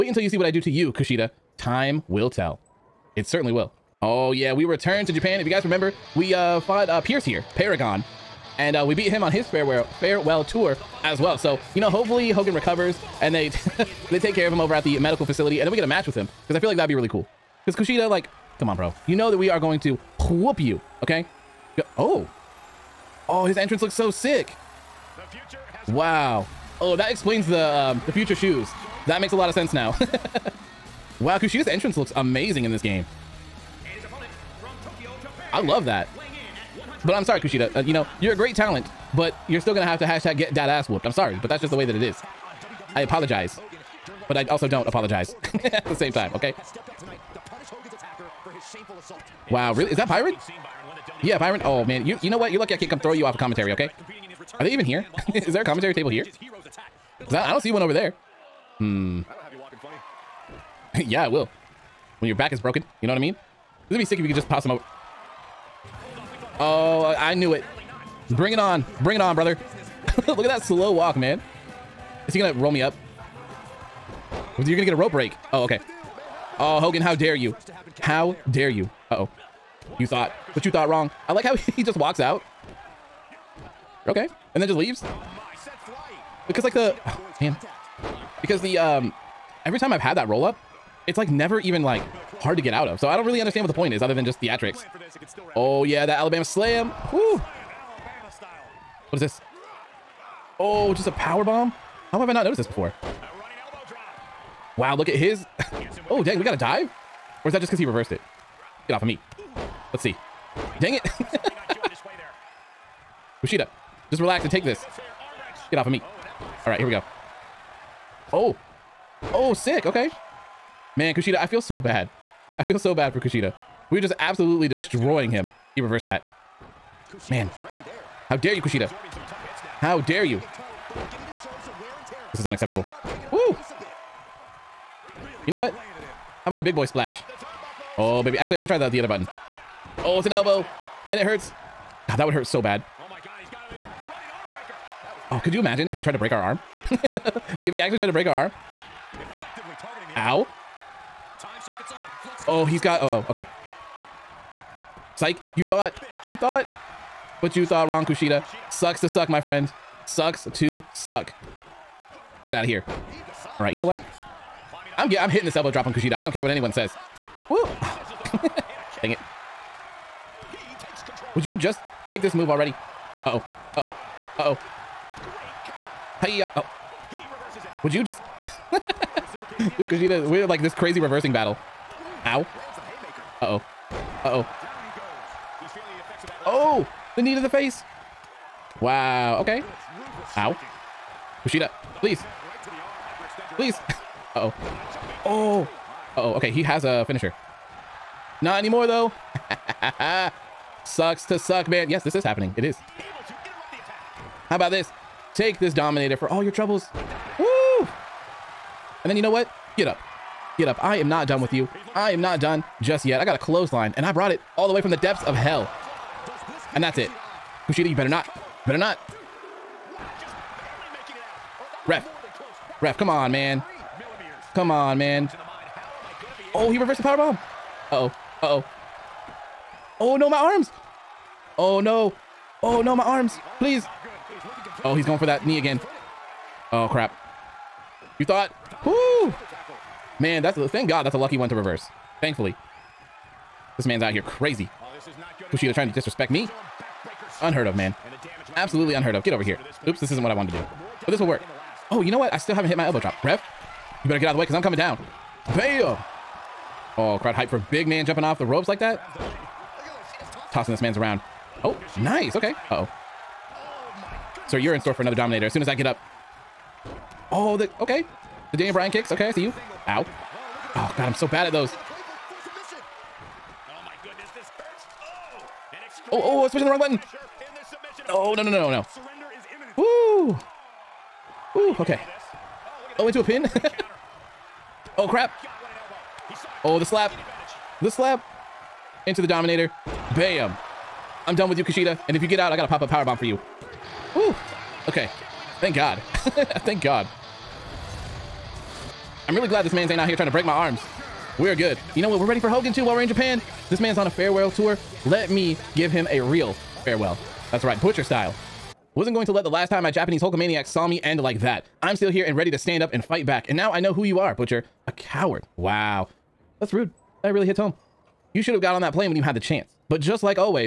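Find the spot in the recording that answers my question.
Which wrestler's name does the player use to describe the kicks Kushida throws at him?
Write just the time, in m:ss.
4:28.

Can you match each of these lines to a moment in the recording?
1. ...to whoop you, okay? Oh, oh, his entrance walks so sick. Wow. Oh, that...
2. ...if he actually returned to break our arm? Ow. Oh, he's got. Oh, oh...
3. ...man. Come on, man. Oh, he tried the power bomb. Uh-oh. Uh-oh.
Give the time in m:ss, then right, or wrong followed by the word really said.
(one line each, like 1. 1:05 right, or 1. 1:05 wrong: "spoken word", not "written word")
1. 0:19 wrong: "looks", not "walks"
2. 2:27 wrong: "tried", not "returned"
3. 3:43 wrong: "reversed", not "tried".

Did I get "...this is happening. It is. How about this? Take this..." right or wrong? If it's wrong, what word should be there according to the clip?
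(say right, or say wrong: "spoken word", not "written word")
right.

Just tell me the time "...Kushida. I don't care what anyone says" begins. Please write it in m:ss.
2:45.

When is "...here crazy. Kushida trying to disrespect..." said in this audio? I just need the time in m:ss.
4:04.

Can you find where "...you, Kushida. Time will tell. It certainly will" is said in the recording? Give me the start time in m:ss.
0:00.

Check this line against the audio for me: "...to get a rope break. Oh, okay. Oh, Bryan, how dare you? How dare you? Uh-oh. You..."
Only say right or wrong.
wrong.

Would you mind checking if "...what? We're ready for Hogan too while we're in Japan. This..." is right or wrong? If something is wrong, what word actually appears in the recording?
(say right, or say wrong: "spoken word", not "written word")
right.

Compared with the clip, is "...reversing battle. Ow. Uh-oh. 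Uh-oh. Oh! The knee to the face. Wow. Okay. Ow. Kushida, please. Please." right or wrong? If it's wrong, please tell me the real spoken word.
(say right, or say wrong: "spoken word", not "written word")
right.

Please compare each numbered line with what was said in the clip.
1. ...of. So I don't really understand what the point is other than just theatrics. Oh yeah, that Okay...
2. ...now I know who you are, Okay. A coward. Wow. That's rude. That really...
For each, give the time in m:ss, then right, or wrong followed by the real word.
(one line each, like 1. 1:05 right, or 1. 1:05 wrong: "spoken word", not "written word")
1. 1:32 wrong: "Alabama", not "Okay"
2. 5:13 wrong: "Butcher", not "Okay".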